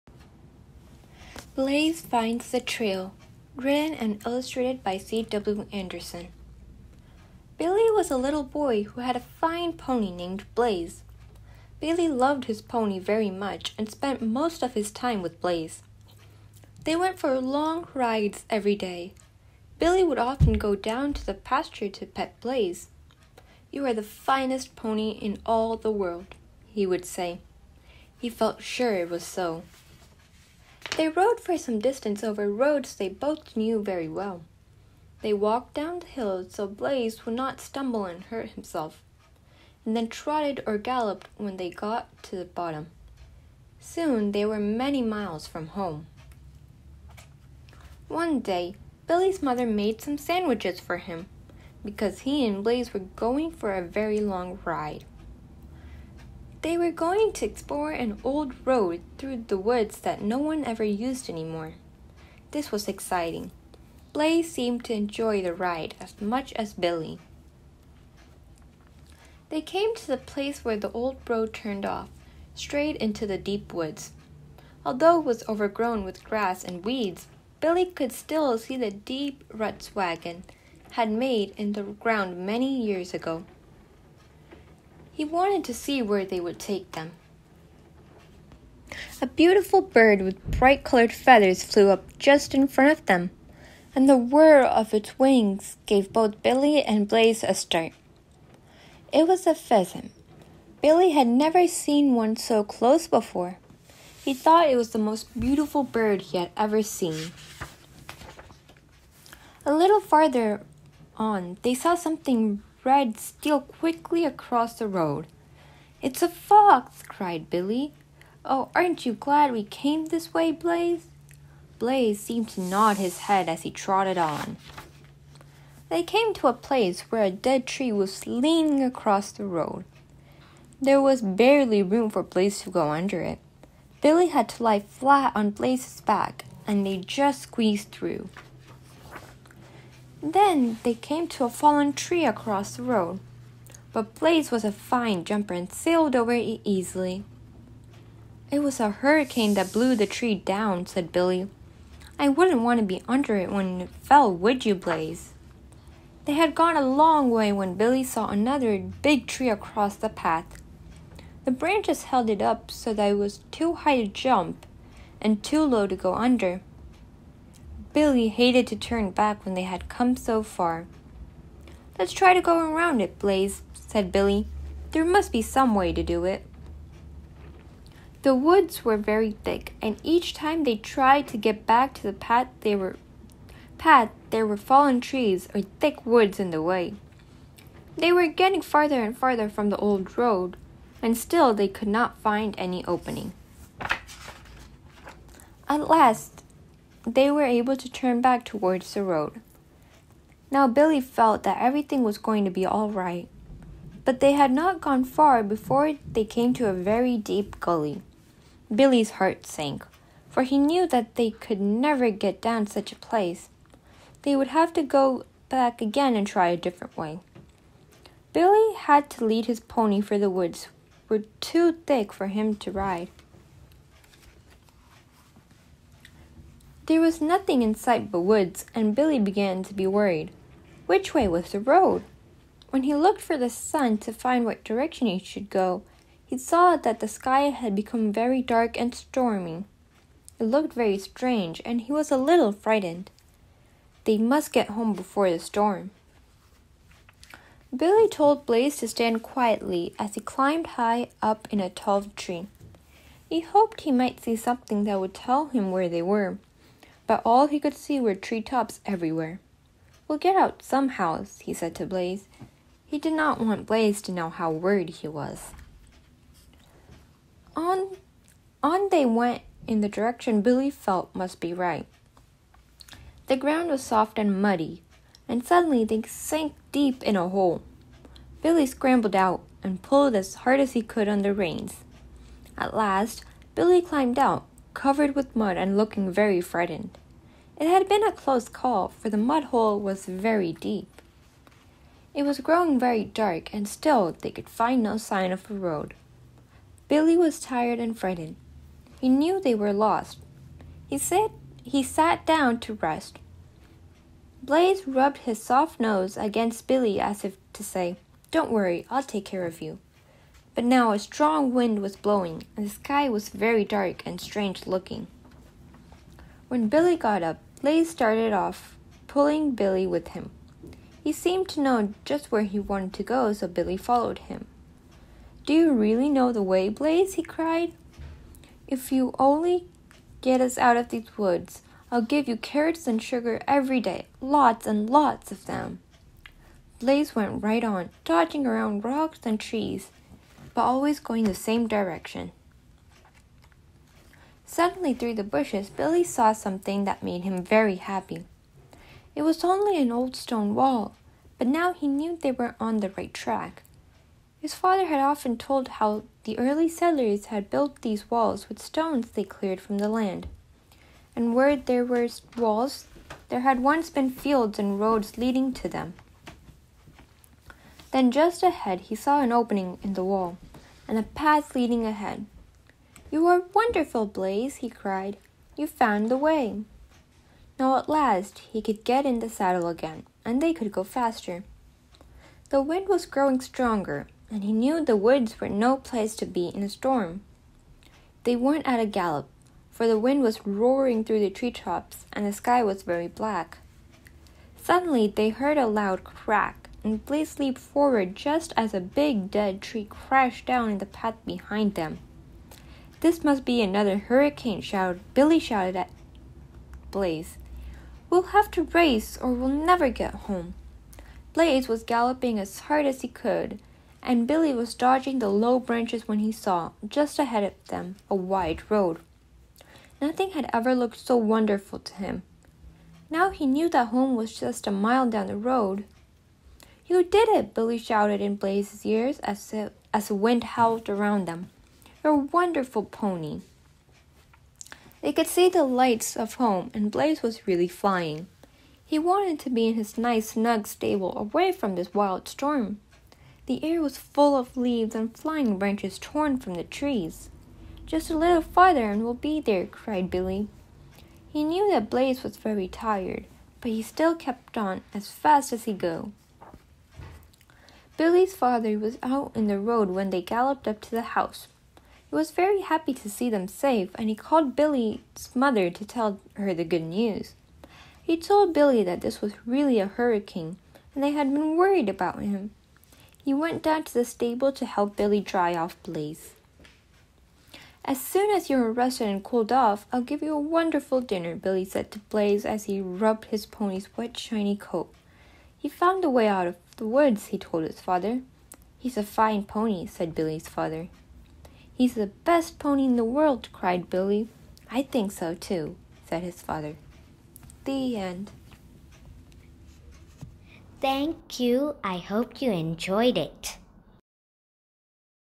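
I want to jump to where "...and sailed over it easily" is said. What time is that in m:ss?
2:25.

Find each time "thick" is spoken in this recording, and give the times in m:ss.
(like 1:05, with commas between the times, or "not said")
2:59, 3:05, 3:41.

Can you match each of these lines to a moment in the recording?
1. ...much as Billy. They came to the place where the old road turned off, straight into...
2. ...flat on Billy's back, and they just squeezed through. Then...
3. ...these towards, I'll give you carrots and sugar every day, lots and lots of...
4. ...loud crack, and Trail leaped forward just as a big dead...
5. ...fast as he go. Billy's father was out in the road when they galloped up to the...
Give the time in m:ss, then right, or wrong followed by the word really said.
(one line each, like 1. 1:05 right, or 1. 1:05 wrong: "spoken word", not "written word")
1. 1:06 right
2. 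2:14 wrong: "Blaze", not "Billy"
3. 5:30 wrong: "woods", not "towards"
4. 6:35 wrong: "Blaze", not "Trail"
5. 7:35 right.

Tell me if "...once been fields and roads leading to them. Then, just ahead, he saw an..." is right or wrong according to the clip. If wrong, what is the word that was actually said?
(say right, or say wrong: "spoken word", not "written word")
right.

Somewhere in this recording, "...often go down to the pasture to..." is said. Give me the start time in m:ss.
0:20.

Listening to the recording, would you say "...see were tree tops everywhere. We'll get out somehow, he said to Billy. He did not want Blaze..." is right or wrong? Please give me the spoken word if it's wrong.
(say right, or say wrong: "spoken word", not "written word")
wrong: "Blaze", not "Billy".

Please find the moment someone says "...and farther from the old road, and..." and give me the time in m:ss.
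3:09.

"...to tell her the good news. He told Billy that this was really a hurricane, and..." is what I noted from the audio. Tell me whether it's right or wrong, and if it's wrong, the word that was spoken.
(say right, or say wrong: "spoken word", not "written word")
right.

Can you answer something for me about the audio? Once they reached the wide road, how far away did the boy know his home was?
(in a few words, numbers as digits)
1 mile.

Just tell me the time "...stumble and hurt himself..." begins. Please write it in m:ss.
0:37.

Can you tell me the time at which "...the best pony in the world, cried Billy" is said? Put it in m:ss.
8:11.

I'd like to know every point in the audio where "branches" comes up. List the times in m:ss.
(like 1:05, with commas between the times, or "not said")
2:41, 6:55, 7:25.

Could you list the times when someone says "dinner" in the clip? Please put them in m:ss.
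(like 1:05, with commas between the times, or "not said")
8:00.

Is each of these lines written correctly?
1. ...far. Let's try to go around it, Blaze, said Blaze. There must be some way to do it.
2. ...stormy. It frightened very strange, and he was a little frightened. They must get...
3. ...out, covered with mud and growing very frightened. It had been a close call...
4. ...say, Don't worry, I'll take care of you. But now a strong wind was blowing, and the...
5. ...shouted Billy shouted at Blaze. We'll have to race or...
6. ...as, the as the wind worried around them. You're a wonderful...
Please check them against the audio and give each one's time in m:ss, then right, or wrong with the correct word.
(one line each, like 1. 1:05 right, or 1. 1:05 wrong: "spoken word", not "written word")
1. 2:50 wrong: "Billy", not "Blaze"
2. 3:58 wrong: "looked", not "frightened"
3. 4:44 wrong: "looking", not "growing"
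4. 5:07 right
5. 6:44 right
6. 7:09 wrong: "howled", not "worried".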